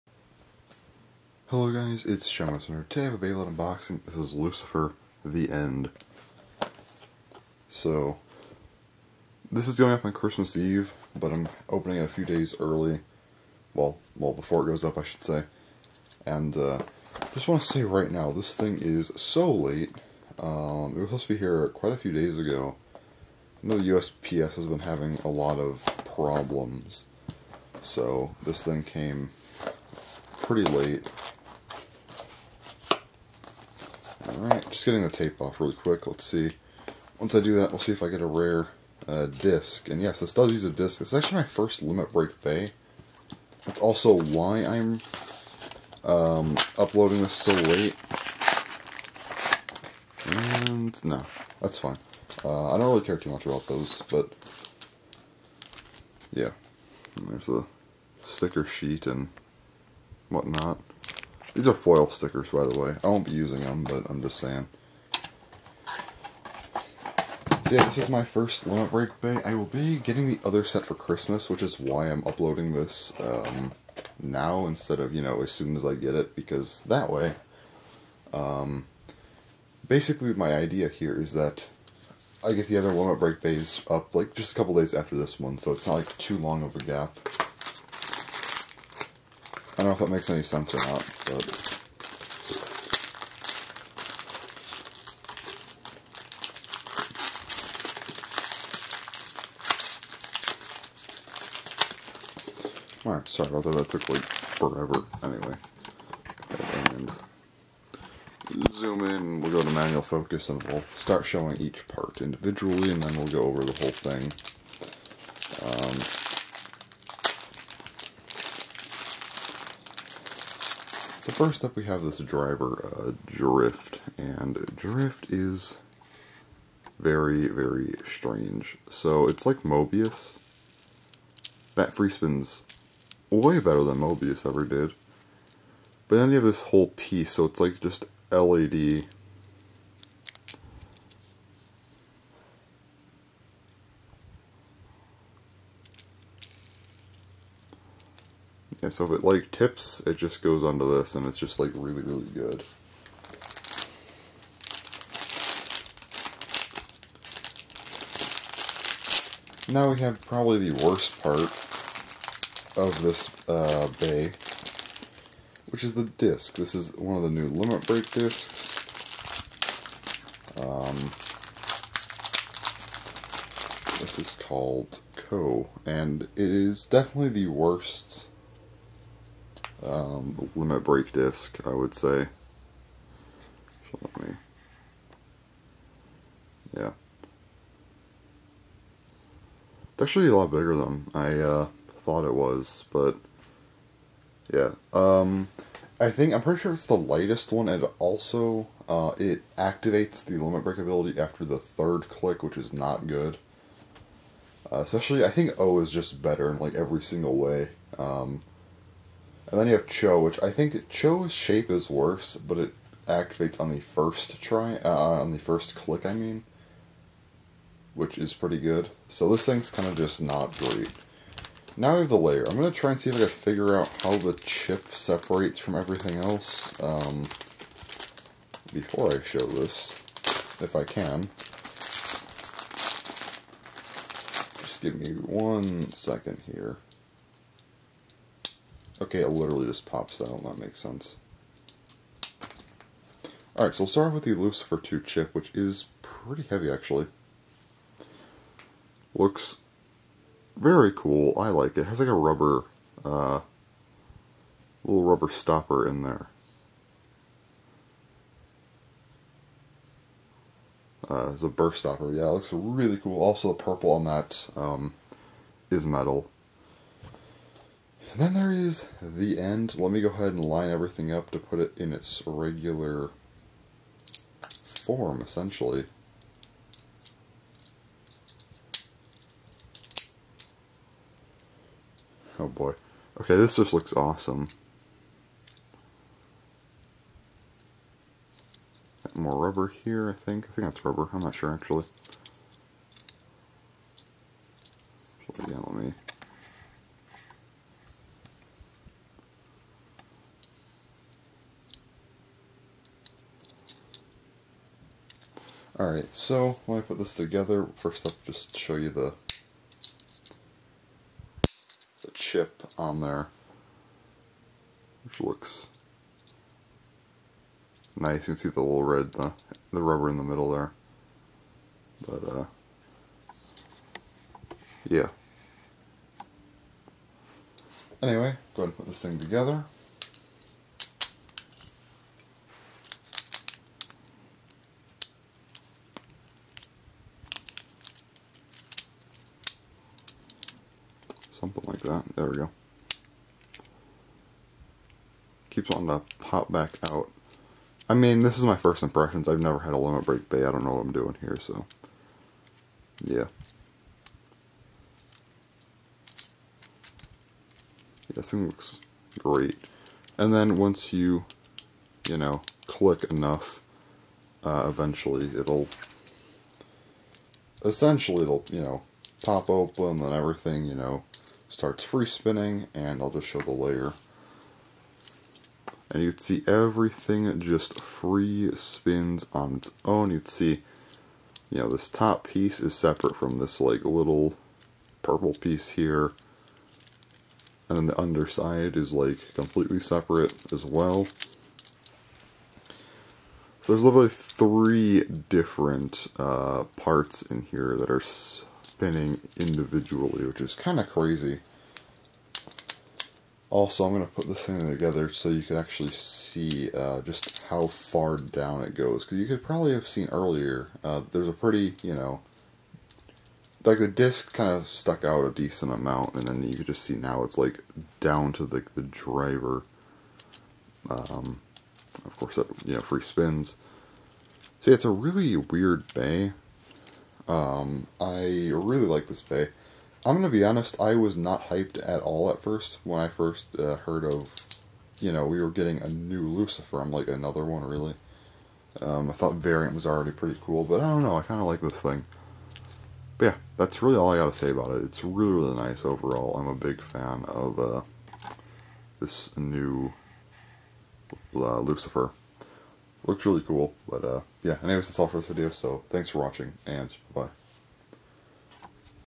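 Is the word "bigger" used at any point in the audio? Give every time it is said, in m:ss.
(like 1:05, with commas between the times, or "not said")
3:10.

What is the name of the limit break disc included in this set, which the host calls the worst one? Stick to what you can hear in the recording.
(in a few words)
Kou.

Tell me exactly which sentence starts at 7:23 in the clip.
But yeah, that's really all I got to say about it.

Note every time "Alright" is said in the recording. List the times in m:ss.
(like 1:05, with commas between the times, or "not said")
0:34, 1:43, 4:03, 5:05.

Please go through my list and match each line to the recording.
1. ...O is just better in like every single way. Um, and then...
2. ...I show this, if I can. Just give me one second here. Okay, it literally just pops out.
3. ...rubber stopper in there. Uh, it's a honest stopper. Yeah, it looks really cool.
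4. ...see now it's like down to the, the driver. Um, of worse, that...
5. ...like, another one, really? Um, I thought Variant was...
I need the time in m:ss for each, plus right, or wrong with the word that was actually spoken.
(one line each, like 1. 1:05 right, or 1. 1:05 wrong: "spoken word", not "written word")
1. 3:25 right
2. 3:49 right
3. 4:15 wrong: "burst", not "honest"
4. 6:56 wrong: "course", not "worse"
5. 7:16 right.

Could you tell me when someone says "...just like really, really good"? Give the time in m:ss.
2:31.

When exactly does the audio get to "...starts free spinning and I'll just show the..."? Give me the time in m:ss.
6:11.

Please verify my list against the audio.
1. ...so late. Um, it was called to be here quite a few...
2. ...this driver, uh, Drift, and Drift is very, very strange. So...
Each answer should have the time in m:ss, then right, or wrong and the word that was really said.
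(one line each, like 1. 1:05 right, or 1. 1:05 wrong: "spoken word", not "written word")
1. 0:19 wrong: "supposed", not "called"
2. 2:02 right.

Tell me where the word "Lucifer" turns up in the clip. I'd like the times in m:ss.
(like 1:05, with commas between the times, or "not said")
0:04, 4:04, 7:16, 7:31.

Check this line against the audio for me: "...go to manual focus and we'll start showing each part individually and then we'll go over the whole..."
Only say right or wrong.
right.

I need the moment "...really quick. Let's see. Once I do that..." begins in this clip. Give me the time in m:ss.
0:35.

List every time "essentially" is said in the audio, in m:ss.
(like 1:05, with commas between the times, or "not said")
4:35, 6:07.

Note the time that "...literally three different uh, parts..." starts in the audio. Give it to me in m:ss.
6:33.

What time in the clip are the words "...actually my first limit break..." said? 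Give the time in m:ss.
0:41.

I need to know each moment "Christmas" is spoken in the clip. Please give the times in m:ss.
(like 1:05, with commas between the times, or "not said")
0:10, 1:10.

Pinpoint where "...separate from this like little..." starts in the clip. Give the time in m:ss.
6:22.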